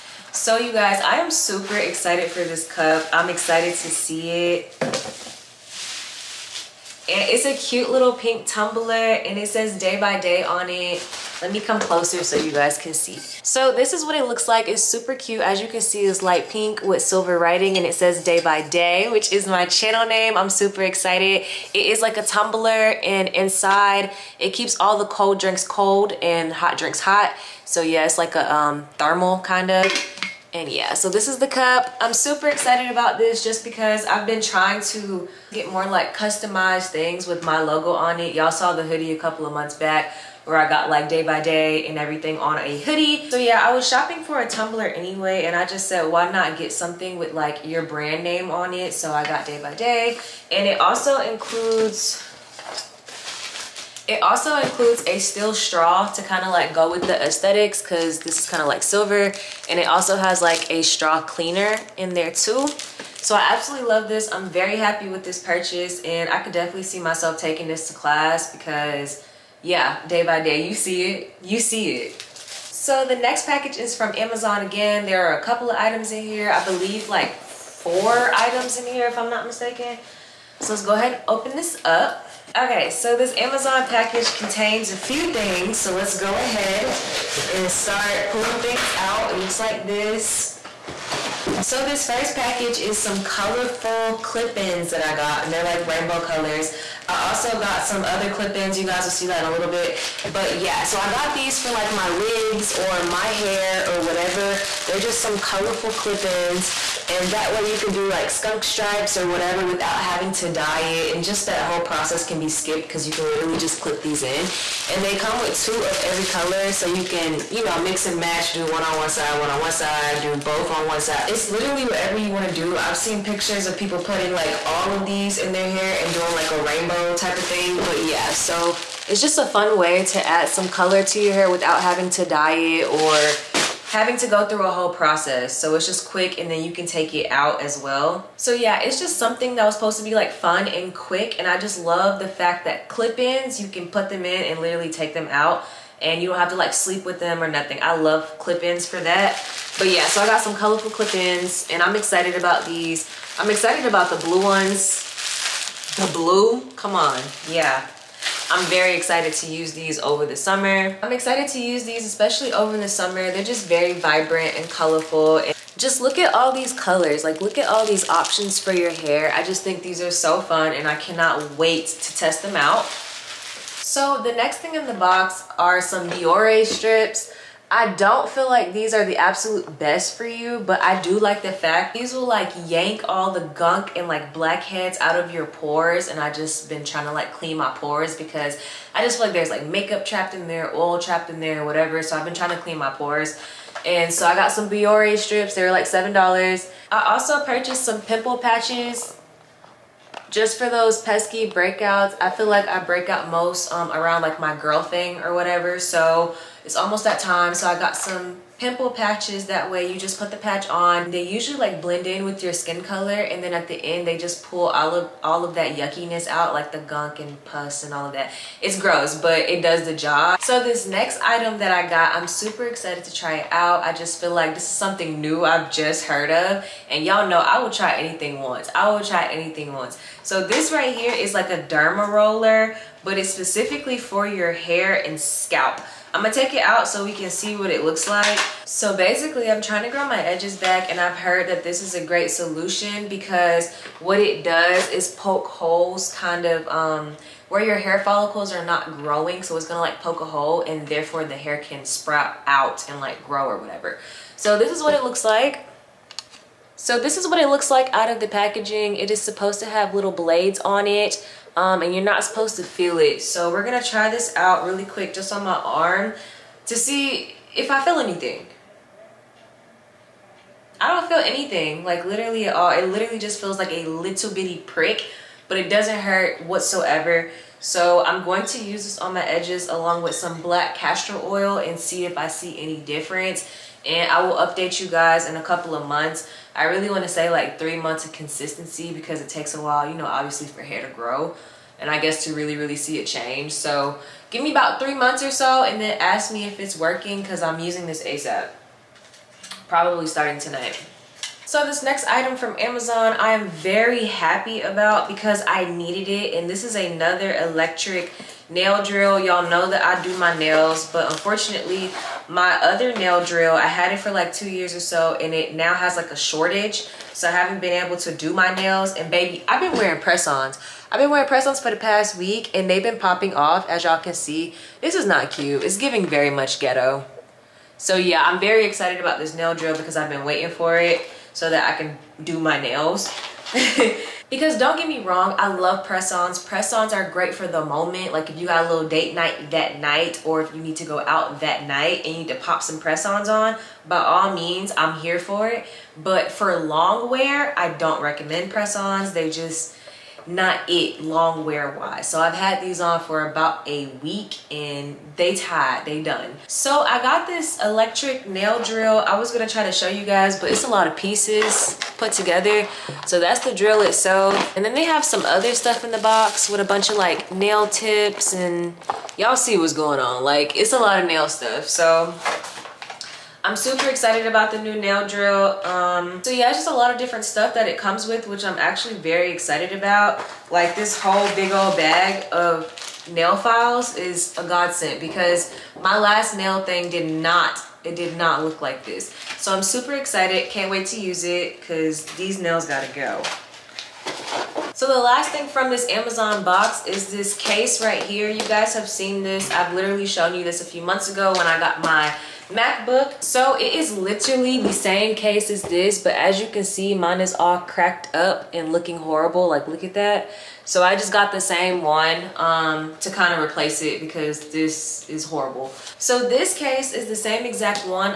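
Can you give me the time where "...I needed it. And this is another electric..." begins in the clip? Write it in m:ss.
5:05.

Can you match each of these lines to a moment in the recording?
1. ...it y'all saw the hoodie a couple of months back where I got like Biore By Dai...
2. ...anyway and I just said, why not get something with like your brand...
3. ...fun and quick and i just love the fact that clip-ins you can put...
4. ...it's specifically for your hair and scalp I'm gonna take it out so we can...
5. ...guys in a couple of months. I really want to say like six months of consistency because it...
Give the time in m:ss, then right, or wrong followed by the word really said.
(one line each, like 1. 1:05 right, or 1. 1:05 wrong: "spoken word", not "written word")
1. 0:38 wrong: "Day", not "Biore"
2. 0:44 right
3. 2:20 right
4. 3:53 right
5. 4:44 wrong: "three", not "six".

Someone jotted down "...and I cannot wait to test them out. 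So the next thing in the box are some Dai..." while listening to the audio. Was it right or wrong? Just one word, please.
wrong.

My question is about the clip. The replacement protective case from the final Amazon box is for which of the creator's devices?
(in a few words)
MacBook.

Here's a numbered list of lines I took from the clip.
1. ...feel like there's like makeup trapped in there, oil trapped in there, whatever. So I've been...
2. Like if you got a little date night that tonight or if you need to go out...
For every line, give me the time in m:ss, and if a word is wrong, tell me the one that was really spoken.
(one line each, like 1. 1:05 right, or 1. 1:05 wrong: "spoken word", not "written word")
1. 3:09 right
2. 5:38 wrong: "night", not "tonight".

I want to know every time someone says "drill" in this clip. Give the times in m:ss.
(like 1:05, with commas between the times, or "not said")
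5:08, 5:13, 5:29, 5:58, 6:03, 6:15.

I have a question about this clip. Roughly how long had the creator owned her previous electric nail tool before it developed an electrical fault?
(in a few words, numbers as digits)
2 years.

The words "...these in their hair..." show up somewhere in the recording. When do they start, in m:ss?
2:05.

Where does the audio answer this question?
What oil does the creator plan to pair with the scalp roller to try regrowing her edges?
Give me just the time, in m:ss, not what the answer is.
4:40.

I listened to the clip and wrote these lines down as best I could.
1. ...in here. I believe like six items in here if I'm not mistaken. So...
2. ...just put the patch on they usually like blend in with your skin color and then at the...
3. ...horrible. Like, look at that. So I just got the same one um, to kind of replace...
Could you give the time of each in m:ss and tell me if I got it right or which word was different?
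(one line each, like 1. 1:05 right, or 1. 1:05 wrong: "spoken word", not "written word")
1. 1:16 wrong: "four", not "six"
2. 3:29 right
3. 6:48 right.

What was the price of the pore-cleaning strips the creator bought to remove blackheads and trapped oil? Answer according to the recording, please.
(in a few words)
$7.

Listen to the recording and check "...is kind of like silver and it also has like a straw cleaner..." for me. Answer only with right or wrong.
right.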